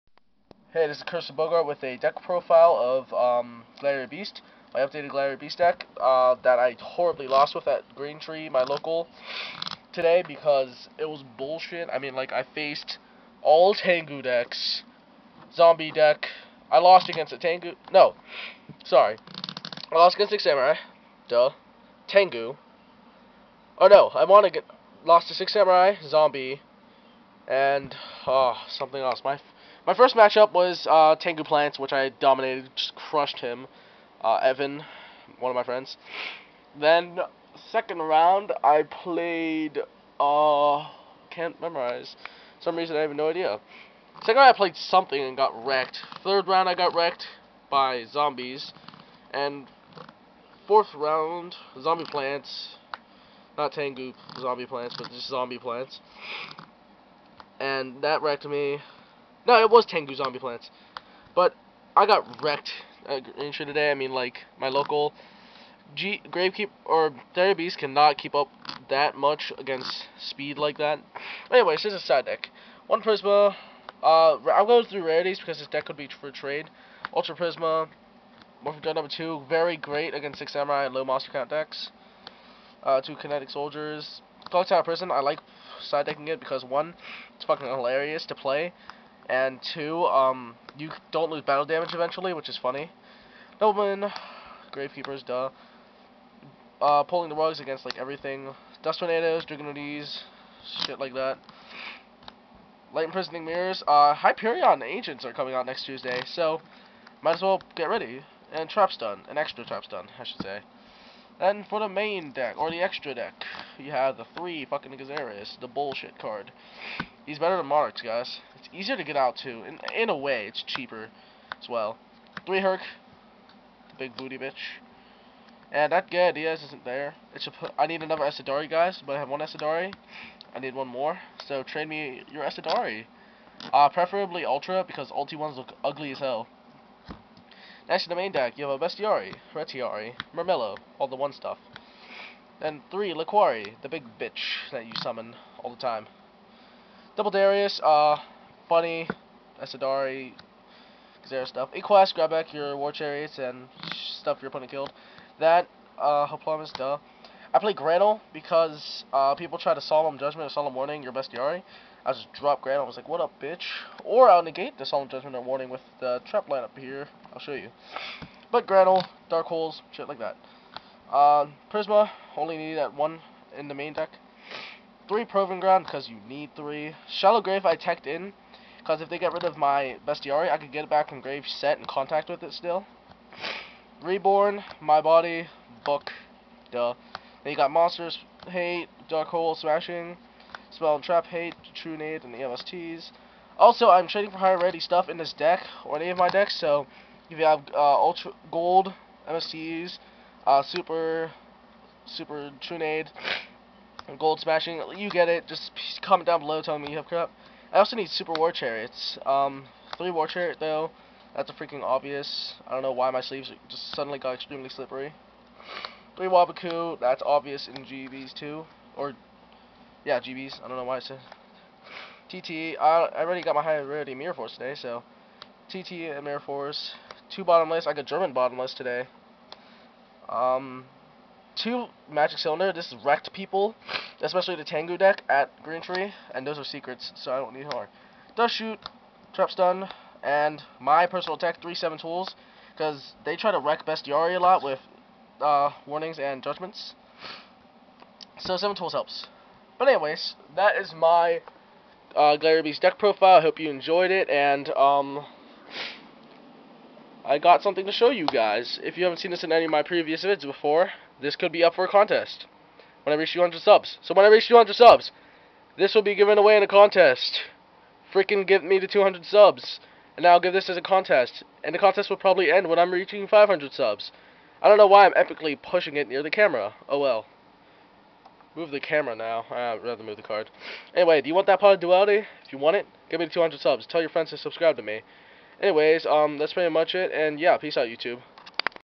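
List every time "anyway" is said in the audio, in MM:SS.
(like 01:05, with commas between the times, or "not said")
01:11, 04:09, 04:40, 04:45.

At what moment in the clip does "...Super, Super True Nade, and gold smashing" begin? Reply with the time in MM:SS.
03:20.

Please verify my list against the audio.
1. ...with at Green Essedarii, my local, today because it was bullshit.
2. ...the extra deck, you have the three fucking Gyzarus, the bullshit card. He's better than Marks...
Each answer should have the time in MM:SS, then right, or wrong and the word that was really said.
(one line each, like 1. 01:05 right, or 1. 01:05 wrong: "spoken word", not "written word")
1. 00:07 wrong: "Tree", not "Essedarii"
2. 01:52 right.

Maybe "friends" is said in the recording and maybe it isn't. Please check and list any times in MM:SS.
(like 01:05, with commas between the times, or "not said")
00:35, 04:44.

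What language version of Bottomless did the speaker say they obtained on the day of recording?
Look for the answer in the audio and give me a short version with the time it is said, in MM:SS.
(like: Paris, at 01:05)
German, at 03:48.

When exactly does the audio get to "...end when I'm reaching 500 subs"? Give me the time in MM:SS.
04:32.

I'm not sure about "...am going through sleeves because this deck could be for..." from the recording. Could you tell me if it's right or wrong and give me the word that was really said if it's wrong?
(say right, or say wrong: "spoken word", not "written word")
wrong: "rarities", not "sleeves".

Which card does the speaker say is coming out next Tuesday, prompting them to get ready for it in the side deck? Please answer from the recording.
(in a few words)
Hyperion.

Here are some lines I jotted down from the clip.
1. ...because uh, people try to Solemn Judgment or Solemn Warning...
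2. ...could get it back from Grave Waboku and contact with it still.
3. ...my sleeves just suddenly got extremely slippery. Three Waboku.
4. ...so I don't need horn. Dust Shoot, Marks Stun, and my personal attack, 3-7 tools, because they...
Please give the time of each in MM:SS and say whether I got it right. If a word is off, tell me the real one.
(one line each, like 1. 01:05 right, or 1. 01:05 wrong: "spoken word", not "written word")
1. 02:38 right
2. 03:00 wrong: "Set", not "Waboku"
3. 03:33 right
4. 03:57 wrong: "Trap", not "Marks".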